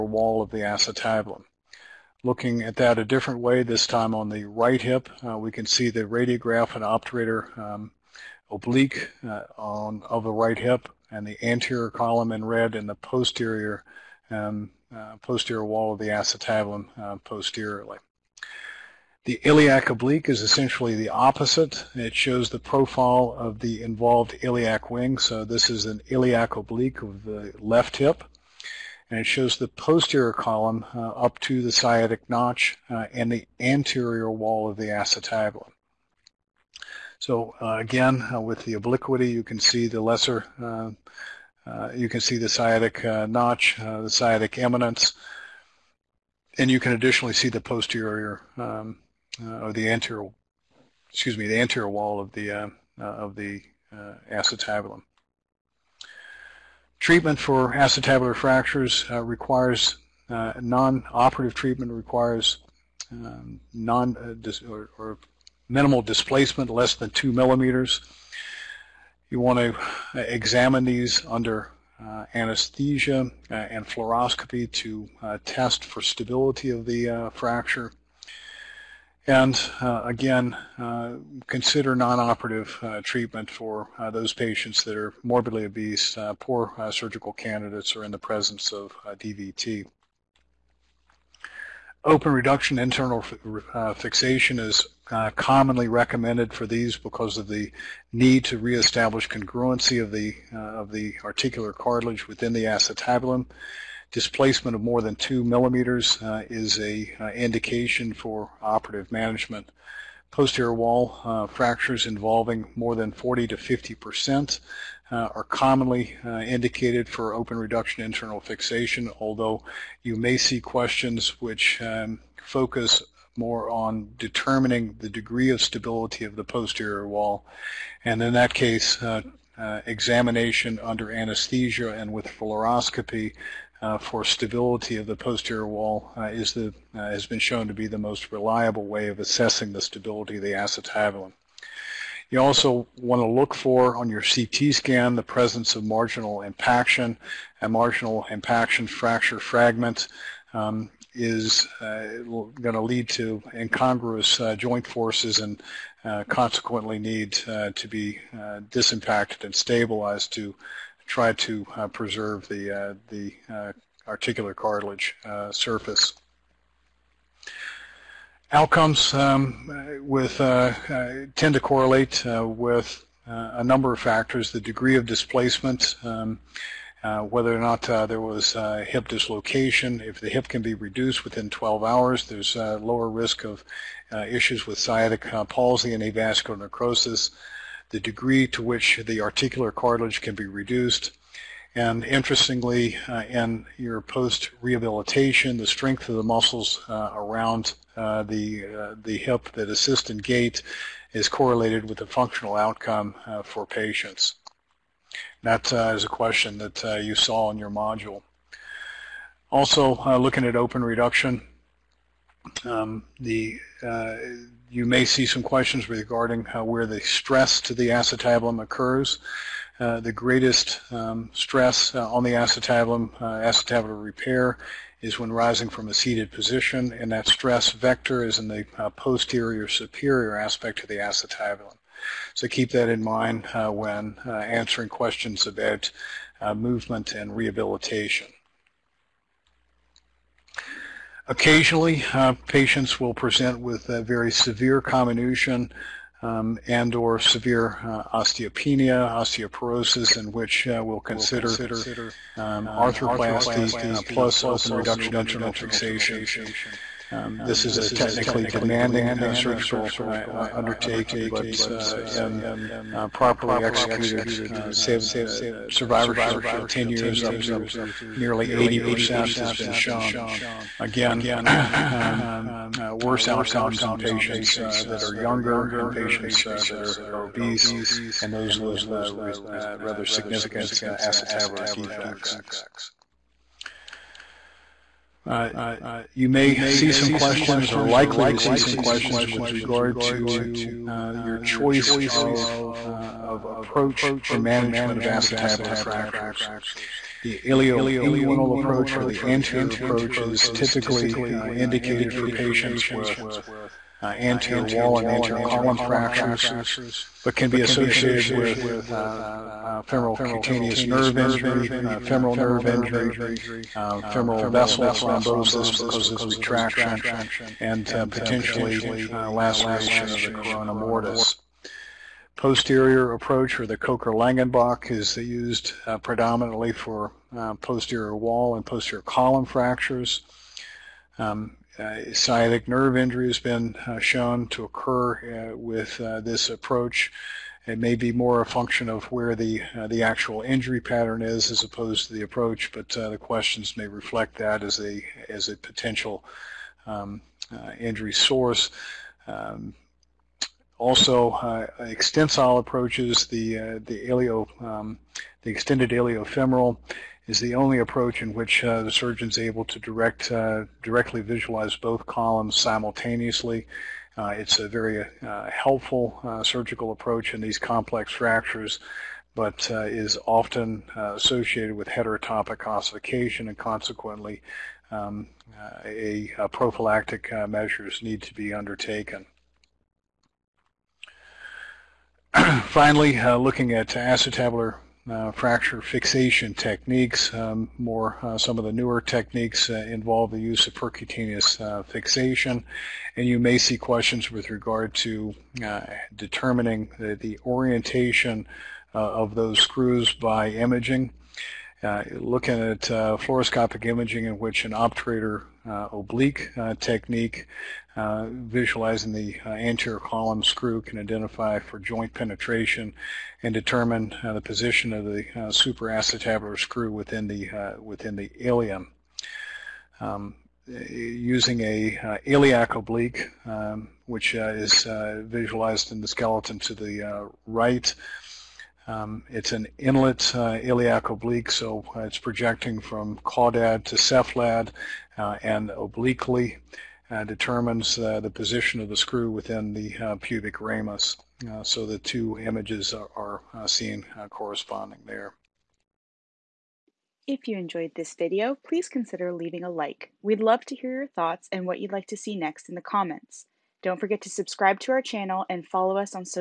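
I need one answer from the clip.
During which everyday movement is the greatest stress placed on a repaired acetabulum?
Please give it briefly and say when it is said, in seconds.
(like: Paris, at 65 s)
Rising from a seated position, at 225 s.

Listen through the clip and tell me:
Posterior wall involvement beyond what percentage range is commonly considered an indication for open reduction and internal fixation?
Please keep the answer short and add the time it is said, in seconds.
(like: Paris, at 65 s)
40 to 50 percent, at 113 s.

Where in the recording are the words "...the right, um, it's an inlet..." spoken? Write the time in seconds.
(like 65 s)
426 s.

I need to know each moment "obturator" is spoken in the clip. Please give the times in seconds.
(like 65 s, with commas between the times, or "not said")
6 s, 404 s.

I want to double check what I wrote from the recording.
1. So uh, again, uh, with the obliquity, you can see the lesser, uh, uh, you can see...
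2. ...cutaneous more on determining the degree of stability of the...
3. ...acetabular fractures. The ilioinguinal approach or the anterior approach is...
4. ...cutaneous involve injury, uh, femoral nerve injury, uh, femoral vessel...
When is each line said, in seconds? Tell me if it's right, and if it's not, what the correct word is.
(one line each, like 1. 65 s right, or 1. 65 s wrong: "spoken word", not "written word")
1. 37 s right
2. 122 s wrong: "focus", not "cutaneous"
3. 295 s right
4. 310 s wrong: "nerve", not "involve".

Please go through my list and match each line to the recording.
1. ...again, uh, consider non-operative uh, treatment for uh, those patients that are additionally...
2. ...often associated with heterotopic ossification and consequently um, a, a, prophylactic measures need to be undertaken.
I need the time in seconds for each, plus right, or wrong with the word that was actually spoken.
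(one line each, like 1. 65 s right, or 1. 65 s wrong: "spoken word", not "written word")
1. 80 s wrong: "morbidly", not "additionally"
2. 370 s right.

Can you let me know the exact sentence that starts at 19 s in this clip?
The iliac oblique is essentially the opposite.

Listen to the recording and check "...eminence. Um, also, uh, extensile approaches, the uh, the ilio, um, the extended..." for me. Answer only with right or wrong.
wrong.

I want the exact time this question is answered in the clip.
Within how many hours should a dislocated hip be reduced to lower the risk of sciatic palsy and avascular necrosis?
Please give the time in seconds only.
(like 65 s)
181 s.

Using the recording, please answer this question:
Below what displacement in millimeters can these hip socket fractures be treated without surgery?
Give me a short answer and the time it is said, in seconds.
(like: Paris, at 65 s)
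less than 2 millimeters, at 66 s.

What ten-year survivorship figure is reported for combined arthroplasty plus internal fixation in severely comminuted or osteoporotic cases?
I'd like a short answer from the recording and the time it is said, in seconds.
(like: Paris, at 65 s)
nearly 80%, at 268 s.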